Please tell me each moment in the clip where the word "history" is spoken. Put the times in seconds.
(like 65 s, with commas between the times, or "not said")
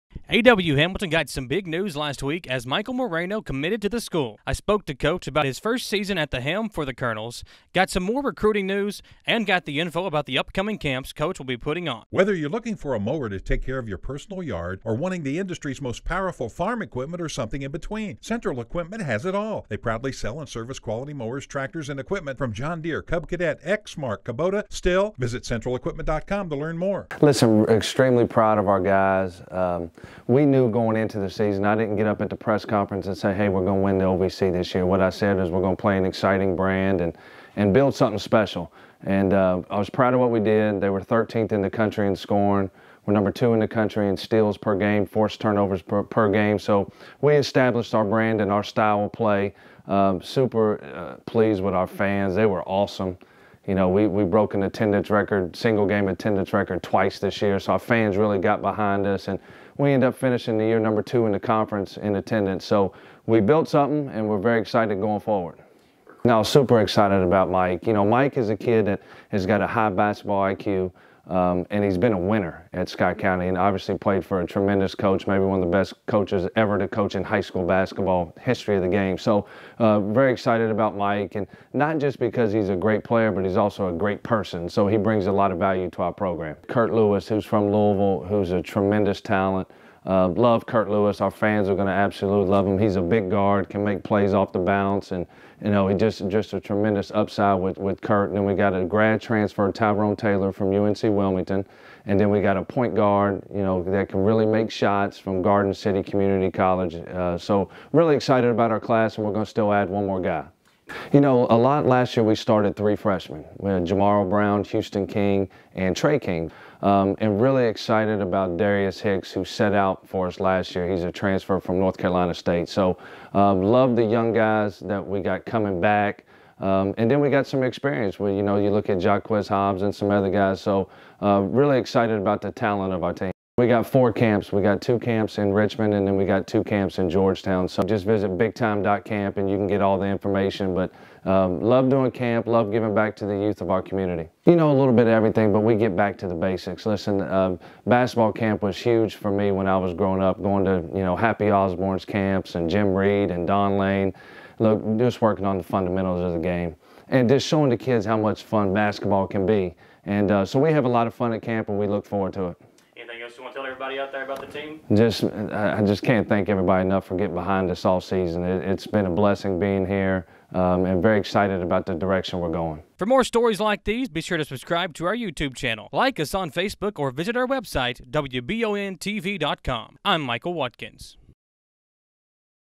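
78 s.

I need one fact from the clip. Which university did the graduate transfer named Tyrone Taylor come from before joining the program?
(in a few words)
UNC Wilmington.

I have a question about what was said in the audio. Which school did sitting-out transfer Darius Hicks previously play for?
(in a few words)
North Carolina State.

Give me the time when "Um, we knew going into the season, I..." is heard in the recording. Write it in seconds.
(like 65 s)
29 s.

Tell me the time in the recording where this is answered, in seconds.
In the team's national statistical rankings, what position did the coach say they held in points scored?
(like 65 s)
41 s.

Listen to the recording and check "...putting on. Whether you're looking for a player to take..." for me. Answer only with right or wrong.
wrong.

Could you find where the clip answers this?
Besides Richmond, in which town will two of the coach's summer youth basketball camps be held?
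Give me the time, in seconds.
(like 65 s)
137 s.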